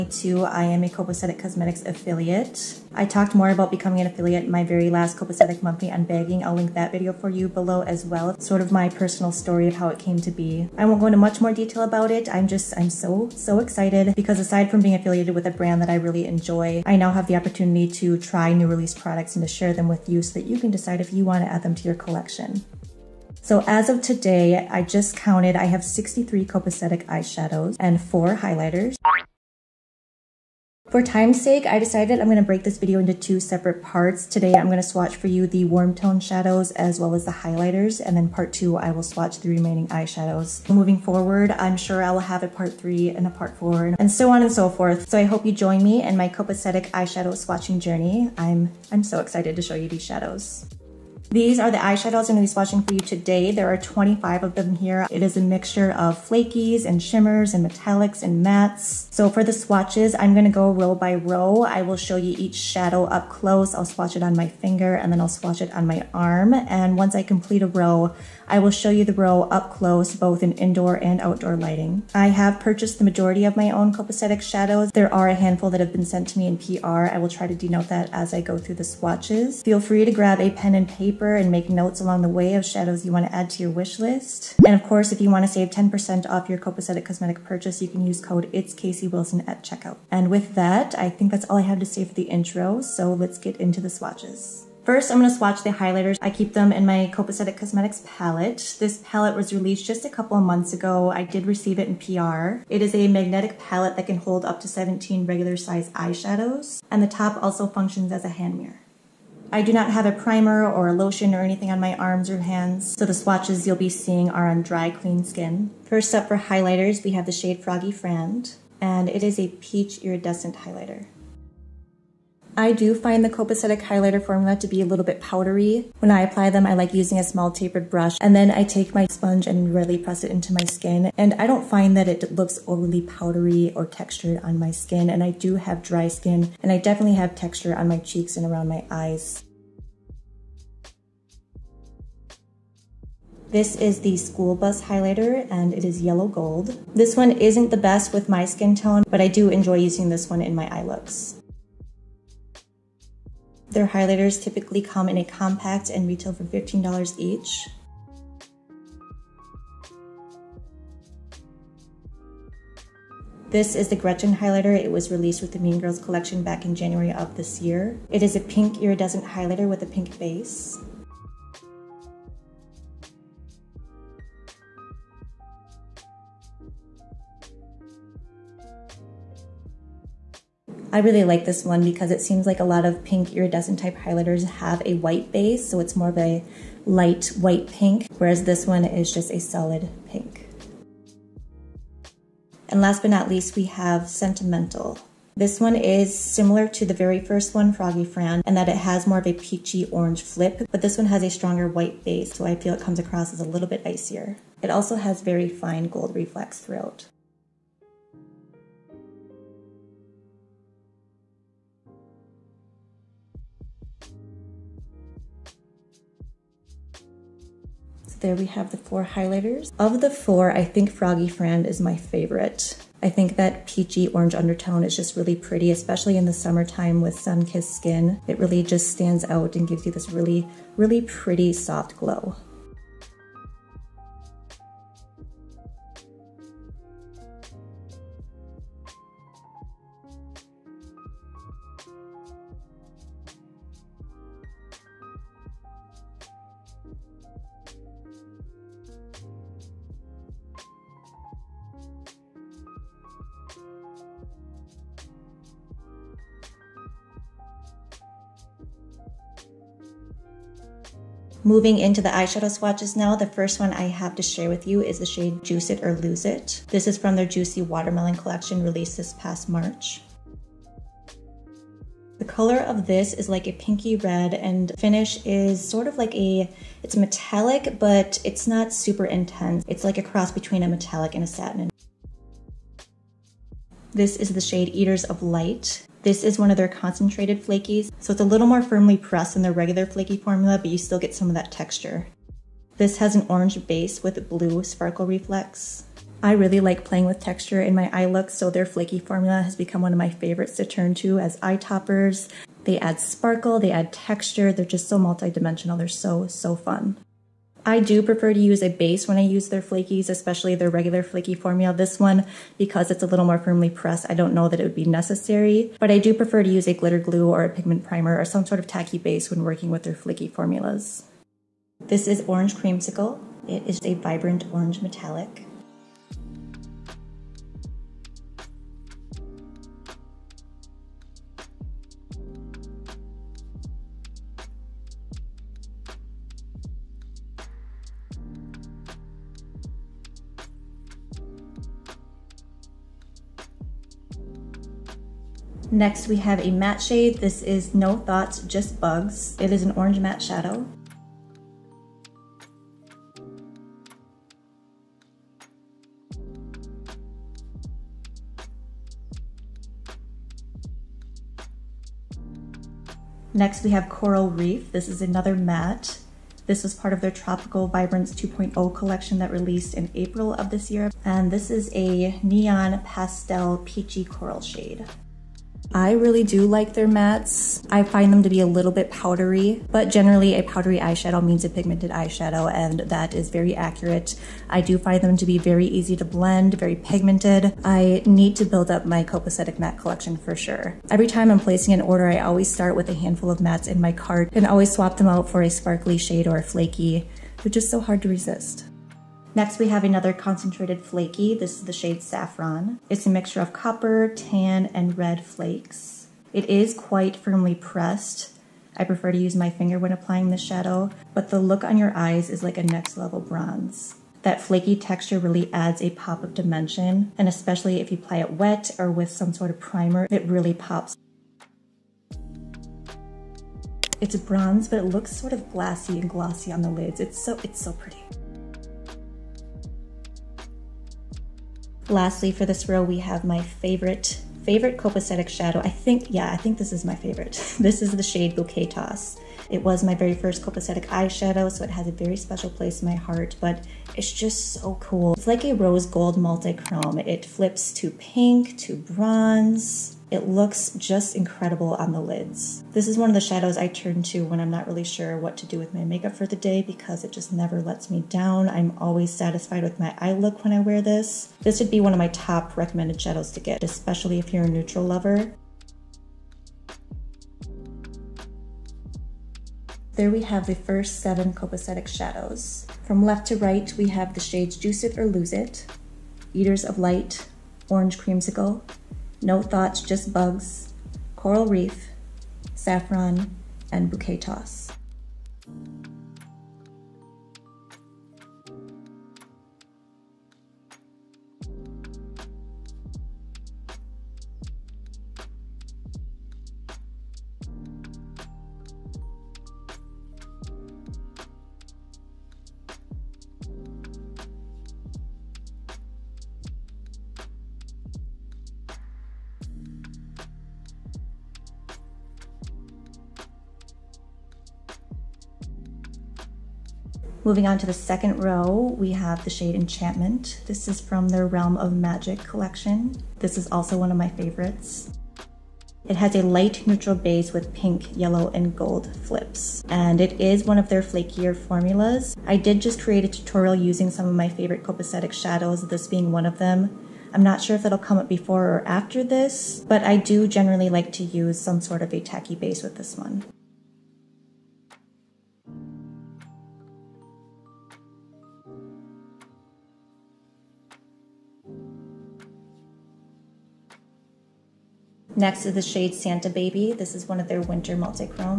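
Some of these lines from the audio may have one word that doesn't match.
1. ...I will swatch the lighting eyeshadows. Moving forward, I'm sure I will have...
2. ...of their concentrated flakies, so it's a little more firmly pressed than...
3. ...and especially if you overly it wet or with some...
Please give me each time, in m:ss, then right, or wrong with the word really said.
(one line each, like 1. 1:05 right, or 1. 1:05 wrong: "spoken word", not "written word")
1. 0:38 wrong: "remaining", not "lighting"
2. 4:46 right
3. 6:57 wrong: "apply", not "overly".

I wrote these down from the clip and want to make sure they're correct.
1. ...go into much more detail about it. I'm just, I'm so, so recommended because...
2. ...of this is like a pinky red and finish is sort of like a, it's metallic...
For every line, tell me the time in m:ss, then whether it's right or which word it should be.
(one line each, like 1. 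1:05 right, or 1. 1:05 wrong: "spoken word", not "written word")
1. 0:10 wrong: "excited", not "recommended"
2. 4:32 right.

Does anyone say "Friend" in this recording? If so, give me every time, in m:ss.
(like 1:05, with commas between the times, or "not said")
1:57, 3:18, 3:41.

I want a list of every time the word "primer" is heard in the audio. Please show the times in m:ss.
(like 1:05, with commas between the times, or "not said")
1:50, 5:17, 6:59.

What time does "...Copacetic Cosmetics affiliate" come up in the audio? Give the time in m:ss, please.
0:00.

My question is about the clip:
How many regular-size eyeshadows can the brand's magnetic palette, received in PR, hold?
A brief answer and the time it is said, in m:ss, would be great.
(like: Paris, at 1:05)
17, at 1:44.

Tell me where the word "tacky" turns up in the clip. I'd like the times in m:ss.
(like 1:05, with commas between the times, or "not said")
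5:18, 9:01.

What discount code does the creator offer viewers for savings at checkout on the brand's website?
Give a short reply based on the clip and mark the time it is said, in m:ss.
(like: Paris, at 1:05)
It's Casey Wilson, at 1:28.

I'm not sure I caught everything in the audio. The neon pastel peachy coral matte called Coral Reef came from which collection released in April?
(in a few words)
Tropical Vibrance 2.0.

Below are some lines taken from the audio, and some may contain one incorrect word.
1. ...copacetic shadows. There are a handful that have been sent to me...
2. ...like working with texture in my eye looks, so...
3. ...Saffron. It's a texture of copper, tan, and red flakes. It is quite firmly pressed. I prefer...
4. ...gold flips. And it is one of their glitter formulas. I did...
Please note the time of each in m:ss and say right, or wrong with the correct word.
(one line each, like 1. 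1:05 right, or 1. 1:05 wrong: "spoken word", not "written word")
1. 1:13 right
2. 4:56 wrong: "playing", not "working"
3. 6:42 wrong: "mixture", not "texture"
4. 8:48 wrong: "flakier", not "glitter".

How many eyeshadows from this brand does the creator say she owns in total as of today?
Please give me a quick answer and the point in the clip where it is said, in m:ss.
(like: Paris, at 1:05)
63, at 0:25.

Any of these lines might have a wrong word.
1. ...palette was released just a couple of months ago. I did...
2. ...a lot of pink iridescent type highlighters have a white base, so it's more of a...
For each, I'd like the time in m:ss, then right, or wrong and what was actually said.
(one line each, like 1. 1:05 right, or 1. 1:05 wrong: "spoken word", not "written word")
1. 1:39 right
2. 3:02 right.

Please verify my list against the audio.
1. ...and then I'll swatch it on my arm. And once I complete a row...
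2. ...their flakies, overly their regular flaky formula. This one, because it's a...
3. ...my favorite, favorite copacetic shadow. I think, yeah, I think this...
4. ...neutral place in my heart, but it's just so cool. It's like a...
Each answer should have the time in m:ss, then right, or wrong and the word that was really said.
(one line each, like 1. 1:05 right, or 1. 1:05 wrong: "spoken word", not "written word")
1. 1:04 right
2. 5:09 wrong: "especially", not "overly"
3. 7:13 right
4. 7:22 wrong: "special", not "neutral".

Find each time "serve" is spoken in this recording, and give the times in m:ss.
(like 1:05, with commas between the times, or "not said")
not said.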